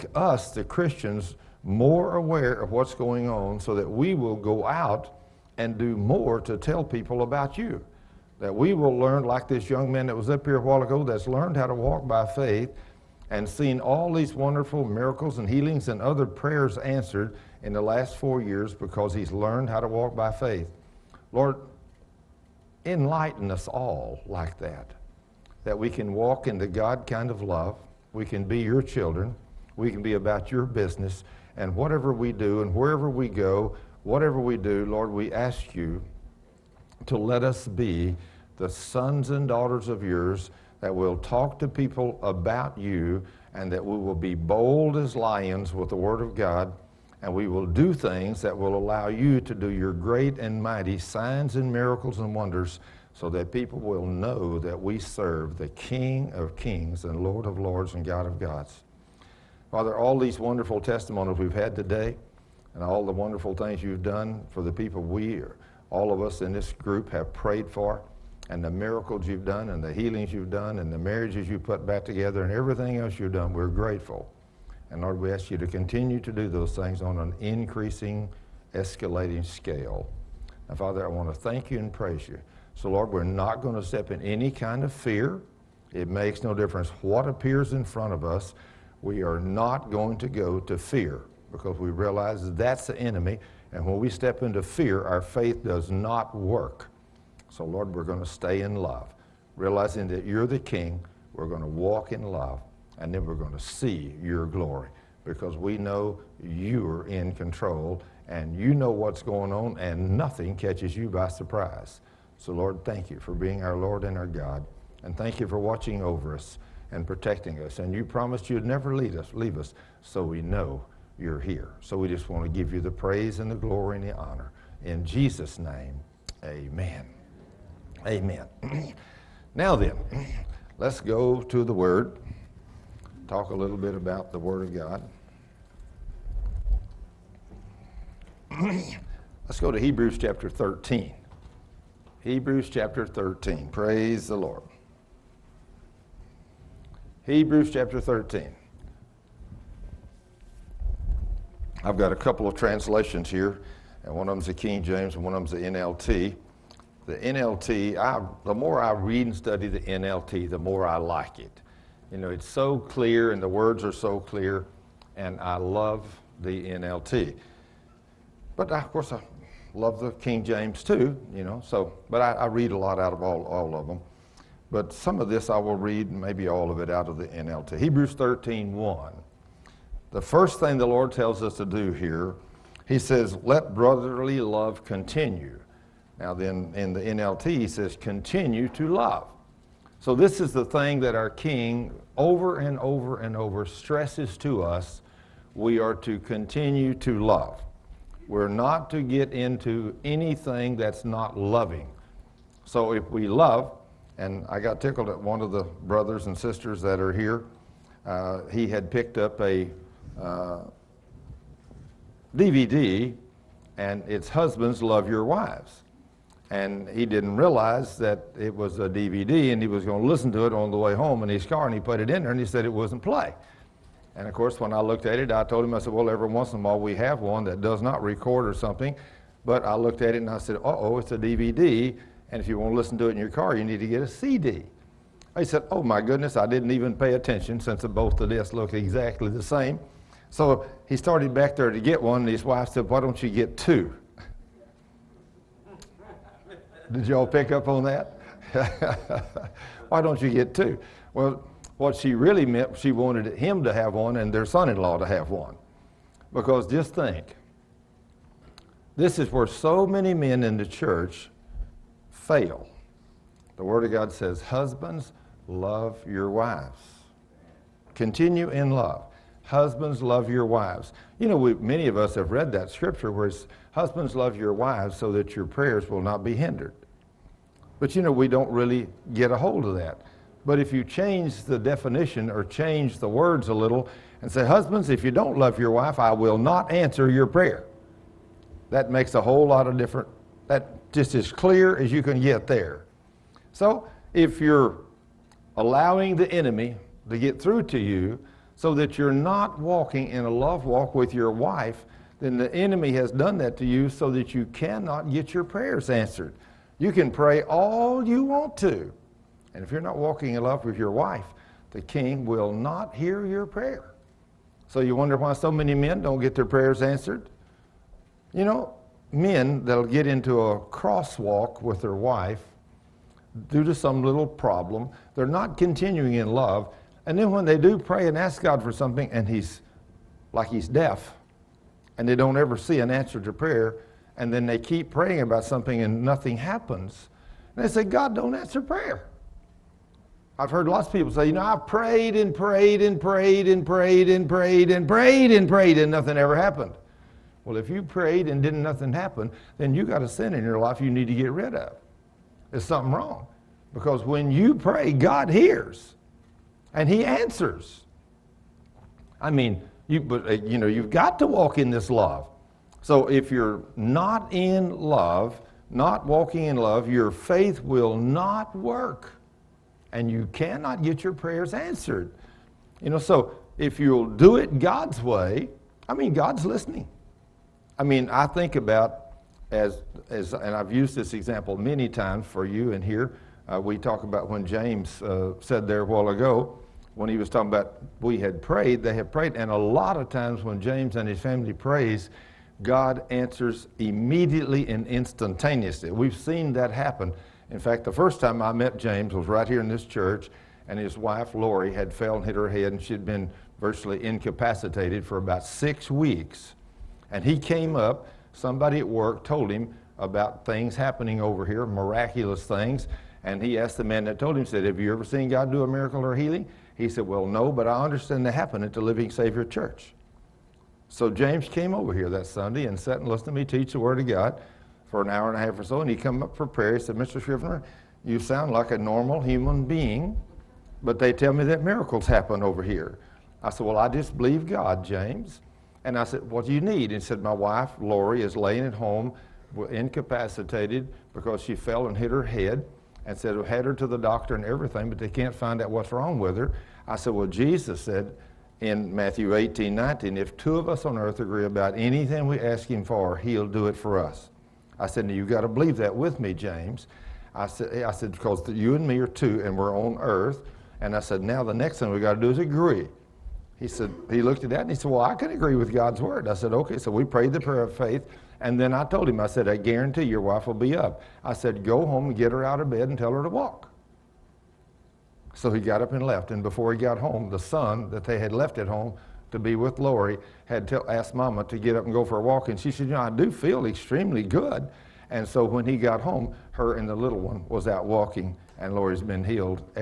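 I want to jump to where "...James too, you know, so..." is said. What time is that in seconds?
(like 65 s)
170 s.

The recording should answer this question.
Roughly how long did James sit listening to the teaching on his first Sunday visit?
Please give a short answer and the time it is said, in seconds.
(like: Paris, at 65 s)
An hour and a half, at 424 s.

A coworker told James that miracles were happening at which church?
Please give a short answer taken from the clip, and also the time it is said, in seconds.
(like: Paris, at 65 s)
Living Savior Church, at 418 s.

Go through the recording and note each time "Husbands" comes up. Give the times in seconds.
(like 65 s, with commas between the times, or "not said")
214 s, 264 s, 269 s, 273 s, 284 s.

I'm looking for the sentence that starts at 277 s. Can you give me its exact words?
But you know, we don't really get a hold of that.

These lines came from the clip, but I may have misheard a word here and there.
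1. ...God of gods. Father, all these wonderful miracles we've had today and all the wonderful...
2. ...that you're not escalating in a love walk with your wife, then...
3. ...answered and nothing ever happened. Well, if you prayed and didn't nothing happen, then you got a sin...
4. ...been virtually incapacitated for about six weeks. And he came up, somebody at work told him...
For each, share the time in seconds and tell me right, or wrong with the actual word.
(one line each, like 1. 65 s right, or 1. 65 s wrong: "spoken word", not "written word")
1. 58 s wrong: "testimonies", not "miracles"
2. 298 s wrong: "walking", not "escalating"
3. 345 s wrong: "prayed", not "answered"
4. 403 s right.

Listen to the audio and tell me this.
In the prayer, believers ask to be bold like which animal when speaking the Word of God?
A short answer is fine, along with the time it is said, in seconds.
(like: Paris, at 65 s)
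Lions, at 45 s.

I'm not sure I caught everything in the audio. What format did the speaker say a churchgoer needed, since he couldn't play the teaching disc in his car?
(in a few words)
CD.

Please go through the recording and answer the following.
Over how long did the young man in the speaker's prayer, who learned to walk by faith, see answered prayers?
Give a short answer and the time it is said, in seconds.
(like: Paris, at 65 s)
4 years, at 18 s.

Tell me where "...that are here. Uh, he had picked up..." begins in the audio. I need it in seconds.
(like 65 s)
206 s.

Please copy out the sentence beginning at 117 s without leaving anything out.
And you promised you'd never lead us, leave us, so we know you're here.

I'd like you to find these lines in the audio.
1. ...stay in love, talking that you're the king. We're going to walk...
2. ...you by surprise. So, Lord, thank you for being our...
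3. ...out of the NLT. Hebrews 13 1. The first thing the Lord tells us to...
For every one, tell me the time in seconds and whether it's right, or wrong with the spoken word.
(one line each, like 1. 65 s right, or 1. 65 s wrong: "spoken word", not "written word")
1. 98 s wrong: "realizing", not "talking"
2. 110 s right
3. 176 s right.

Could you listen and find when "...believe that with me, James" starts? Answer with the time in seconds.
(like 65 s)
455 s.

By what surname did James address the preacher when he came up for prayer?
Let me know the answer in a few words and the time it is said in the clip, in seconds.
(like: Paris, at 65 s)
Scrivner, at 427 s.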